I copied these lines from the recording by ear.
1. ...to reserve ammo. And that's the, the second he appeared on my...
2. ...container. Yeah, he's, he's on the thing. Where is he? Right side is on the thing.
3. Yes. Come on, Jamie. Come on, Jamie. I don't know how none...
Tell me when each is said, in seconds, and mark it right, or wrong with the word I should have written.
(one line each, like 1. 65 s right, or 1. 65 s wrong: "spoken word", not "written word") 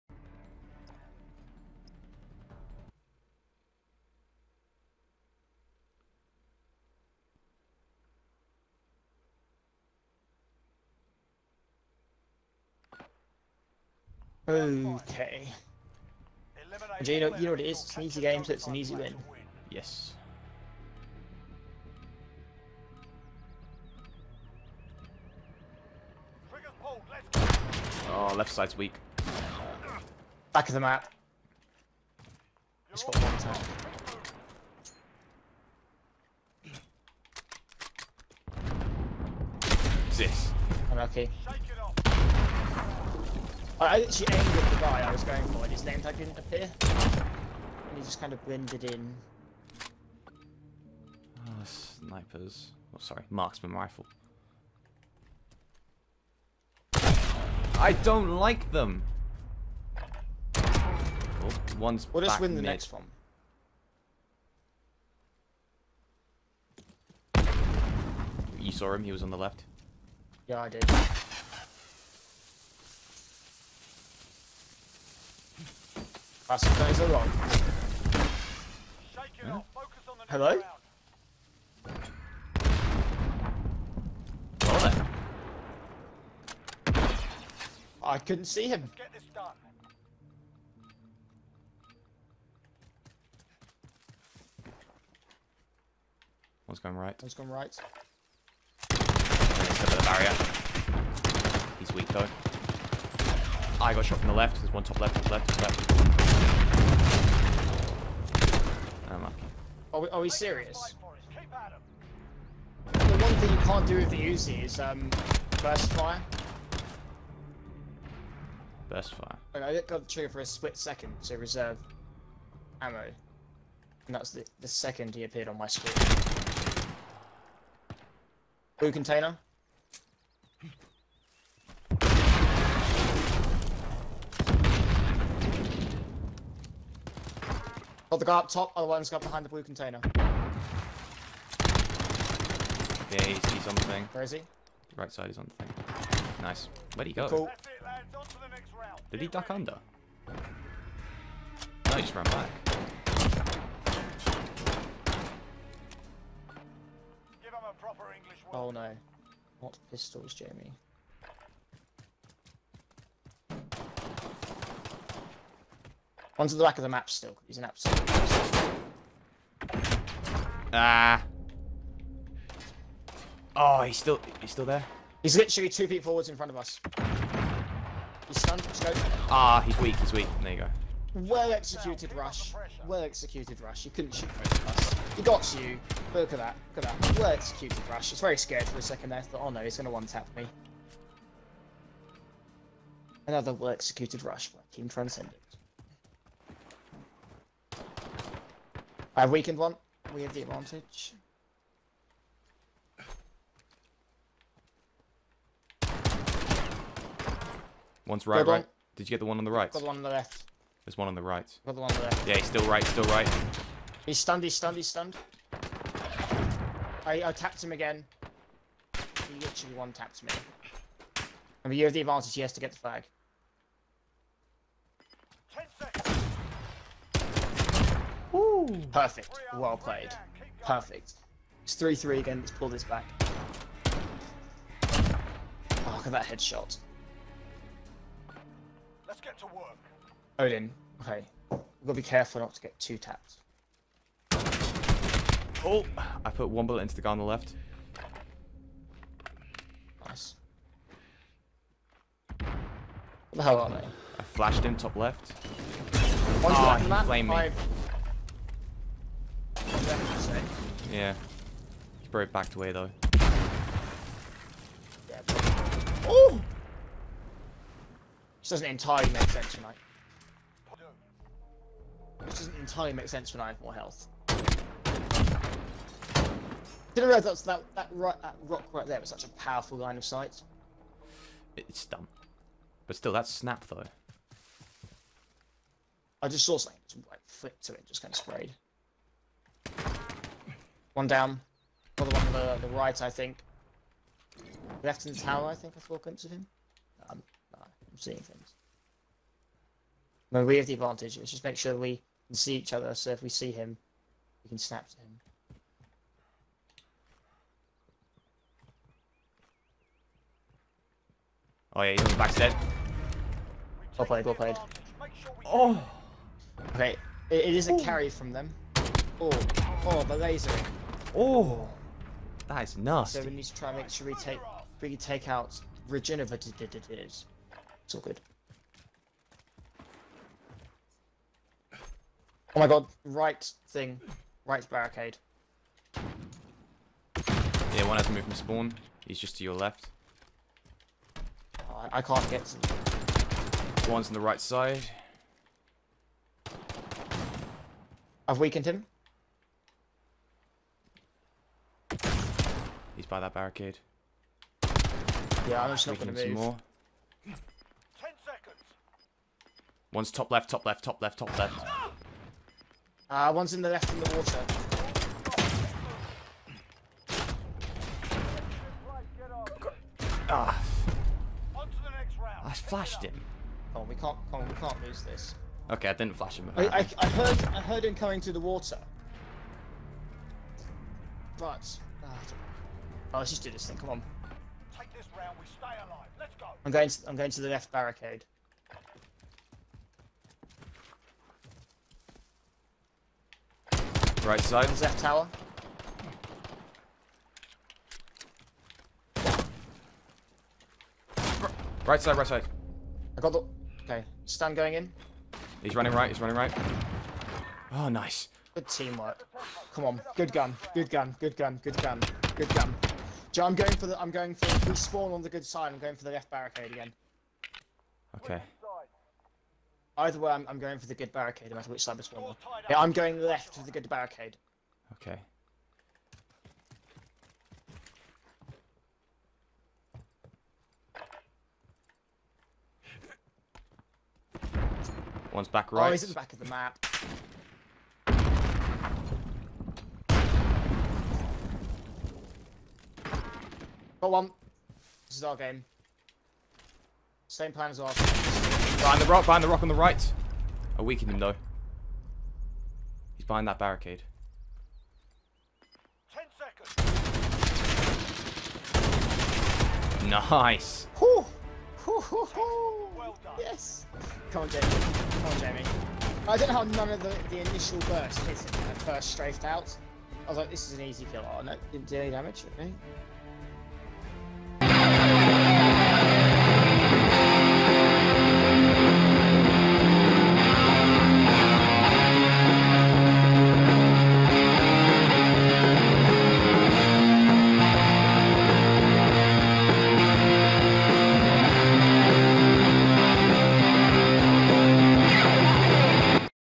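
1. 121 s right
2. 139 s right
3. 463 s right.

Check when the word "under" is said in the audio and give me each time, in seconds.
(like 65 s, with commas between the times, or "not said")
149 s.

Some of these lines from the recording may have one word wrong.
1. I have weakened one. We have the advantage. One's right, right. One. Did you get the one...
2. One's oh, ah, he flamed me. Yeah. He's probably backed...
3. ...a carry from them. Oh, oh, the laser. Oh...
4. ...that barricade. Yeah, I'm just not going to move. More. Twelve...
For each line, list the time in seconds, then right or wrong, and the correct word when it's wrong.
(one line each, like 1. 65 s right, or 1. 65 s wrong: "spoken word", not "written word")
1. 199 s right
2. 256 s right
3. 317 s right
4. 353 s wrong: "Ten", not "Twelve".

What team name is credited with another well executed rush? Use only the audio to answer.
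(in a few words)
Team Transcendent.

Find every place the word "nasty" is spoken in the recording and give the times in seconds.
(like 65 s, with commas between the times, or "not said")
322 s.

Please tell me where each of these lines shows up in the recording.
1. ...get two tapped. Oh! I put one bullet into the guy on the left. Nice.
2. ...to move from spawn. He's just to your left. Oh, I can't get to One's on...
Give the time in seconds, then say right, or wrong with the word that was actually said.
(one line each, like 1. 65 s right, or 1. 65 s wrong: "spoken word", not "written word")
1. 242 s right
2. 338 s right.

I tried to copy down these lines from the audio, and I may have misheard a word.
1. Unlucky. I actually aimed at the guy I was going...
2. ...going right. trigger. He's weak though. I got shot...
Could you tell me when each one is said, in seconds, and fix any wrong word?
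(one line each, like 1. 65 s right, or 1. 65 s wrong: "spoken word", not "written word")
1. 40 s right
2. 97 s wrong: "barrier", not "trigger".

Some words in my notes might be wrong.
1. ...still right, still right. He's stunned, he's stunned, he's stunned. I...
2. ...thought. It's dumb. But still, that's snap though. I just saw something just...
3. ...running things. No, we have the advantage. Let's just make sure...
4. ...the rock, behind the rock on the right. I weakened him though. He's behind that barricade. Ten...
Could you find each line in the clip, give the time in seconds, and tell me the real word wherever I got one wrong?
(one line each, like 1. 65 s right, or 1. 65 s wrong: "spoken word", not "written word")
1. 212 s right
2. 280 s wrong: "sight", not "thought"
3. 297 s wrong: "seeing", not "running"
4. 448 s right.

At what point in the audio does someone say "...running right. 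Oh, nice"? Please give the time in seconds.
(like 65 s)
406 s.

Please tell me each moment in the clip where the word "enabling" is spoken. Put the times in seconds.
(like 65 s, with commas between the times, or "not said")
not said.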